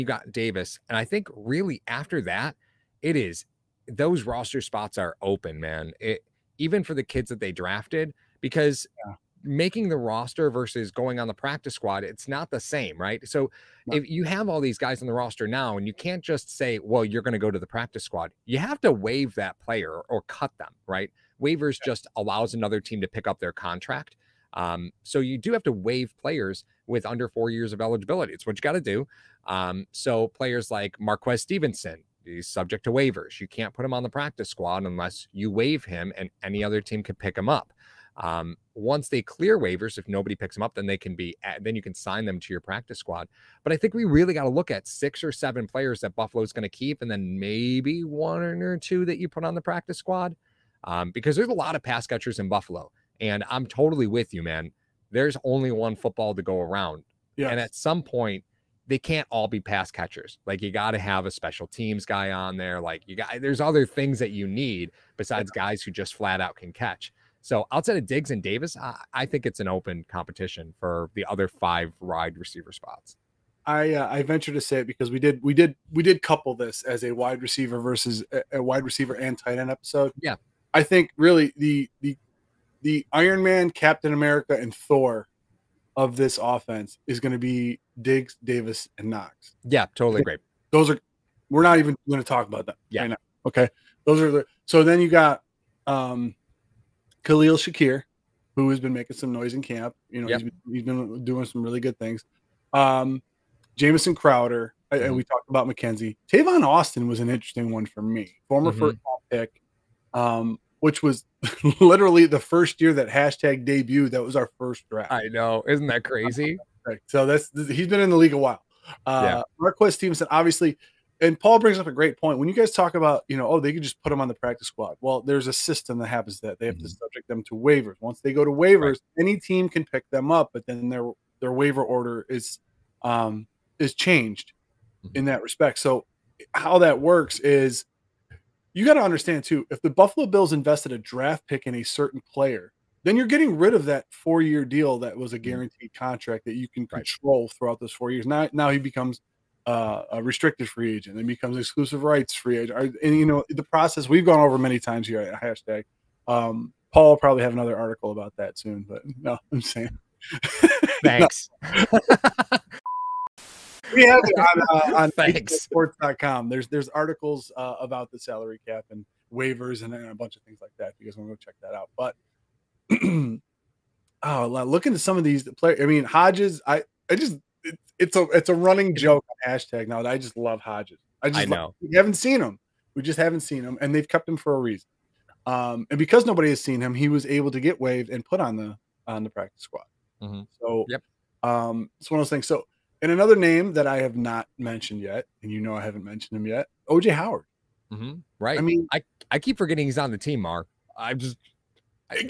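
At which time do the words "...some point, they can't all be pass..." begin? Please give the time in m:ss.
0:57.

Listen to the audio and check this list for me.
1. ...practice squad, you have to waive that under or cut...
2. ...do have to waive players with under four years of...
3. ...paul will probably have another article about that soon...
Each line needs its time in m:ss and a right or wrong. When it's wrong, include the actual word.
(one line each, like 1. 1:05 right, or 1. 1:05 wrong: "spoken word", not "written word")
1. 0:17 wrong: "player", not "under"
2. 0:25 right
3. 2:36 right.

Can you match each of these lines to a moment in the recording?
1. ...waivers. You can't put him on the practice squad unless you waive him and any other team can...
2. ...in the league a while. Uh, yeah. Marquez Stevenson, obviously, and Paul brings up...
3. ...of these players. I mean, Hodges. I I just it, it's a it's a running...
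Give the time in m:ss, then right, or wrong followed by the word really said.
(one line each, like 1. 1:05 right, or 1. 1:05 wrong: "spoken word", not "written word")
1. 0:32 right
2. 1:57 right
3. 2:55 right.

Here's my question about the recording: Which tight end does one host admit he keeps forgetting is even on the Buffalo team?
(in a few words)
OJ Howard.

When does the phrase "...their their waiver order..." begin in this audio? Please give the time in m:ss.
2:10.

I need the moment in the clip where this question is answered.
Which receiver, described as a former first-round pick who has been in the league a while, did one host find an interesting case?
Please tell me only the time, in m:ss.
1:46.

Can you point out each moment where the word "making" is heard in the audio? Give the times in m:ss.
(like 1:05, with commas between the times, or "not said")
0:09, 1:38.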